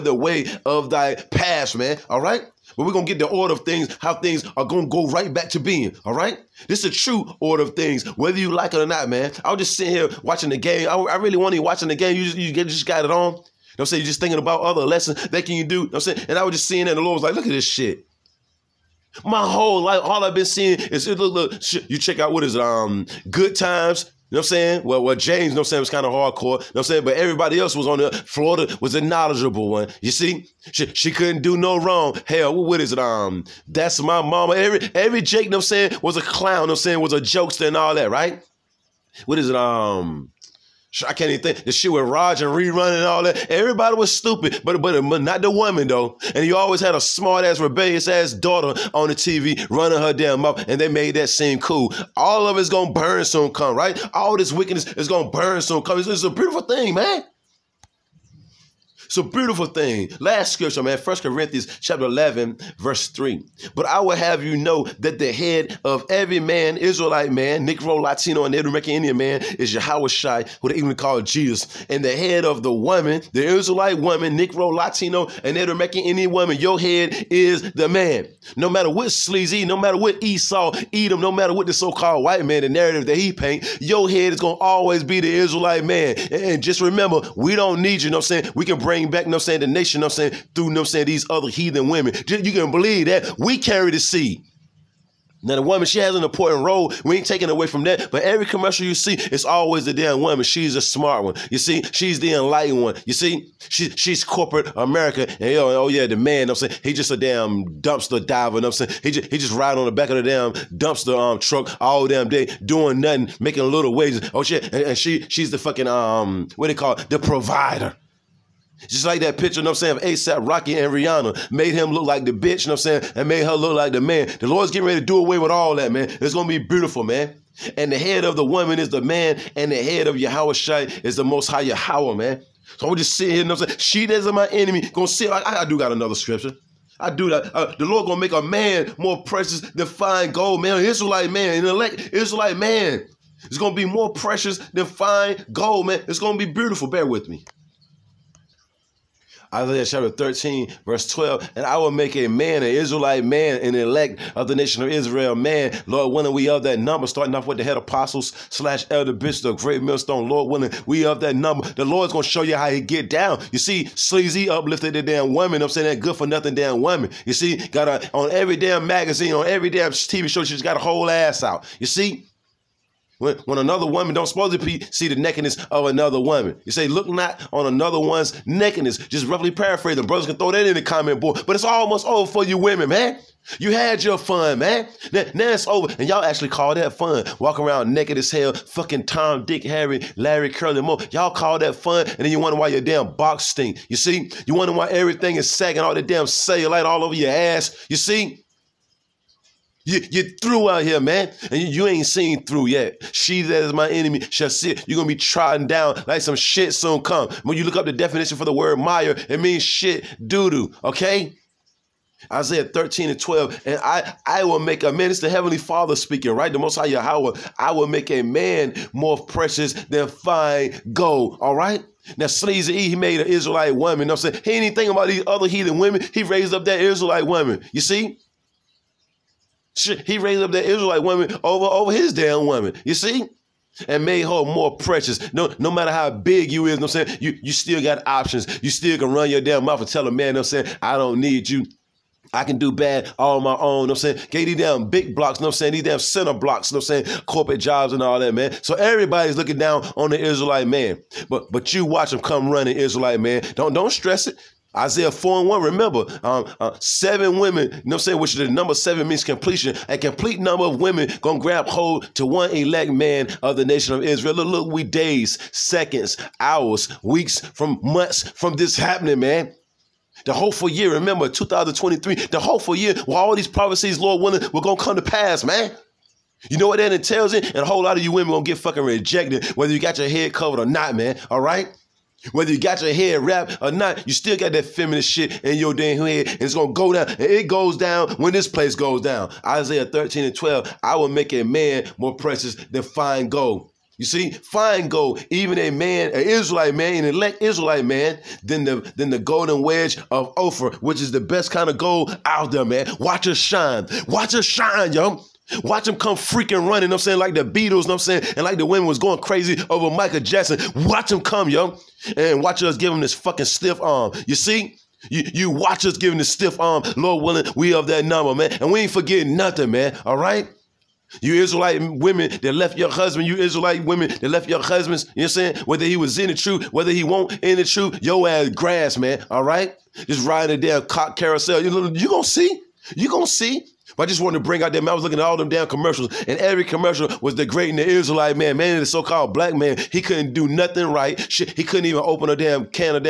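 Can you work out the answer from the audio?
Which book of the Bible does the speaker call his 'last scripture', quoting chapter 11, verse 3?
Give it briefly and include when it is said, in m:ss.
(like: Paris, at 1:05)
First Corinthians, at 1:00.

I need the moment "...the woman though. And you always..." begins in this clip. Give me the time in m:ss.
0:45.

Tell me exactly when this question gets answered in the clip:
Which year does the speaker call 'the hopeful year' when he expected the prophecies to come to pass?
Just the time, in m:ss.
4:31.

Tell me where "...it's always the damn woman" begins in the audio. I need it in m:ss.
1:39.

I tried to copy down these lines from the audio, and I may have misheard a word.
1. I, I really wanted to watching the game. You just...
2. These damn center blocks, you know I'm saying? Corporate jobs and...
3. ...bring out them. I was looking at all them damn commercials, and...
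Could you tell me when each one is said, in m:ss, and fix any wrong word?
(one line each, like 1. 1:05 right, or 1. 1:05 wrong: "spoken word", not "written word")
1. 0:10 right
2. 4:05 right
3. 5:34 right.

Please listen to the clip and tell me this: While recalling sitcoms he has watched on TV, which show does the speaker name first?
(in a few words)
Good Times.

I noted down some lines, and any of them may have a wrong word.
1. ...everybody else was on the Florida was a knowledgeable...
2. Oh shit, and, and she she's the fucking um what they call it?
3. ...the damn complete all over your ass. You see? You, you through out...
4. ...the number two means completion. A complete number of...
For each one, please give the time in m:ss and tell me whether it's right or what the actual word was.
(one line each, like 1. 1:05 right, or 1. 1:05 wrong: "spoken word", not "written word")
1. 0:27 right
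2. 1:54 right
3. 3:15 wrong: "cellulite", not "complete"
4. 4:18 wrong: "seven", not "two".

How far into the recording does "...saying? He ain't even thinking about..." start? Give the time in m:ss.
3:44.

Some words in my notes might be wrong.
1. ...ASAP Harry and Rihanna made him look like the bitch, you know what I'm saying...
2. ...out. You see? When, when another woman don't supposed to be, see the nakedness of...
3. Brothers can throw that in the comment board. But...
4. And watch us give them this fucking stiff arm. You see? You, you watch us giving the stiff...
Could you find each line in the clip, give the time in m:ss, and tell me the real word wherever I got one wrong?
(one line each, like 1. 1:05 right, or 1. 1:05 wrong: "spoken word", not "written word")
1. 2:00 wrong: "Rocky", not "Harry"
2. 2:51 right
3. 3:00 right
4. 5:12 right.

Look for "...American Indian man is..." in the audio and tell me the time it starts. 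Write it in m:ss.
1:08.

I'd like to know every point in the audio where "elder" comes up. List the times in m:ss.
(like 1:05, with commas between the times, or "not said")
2:38.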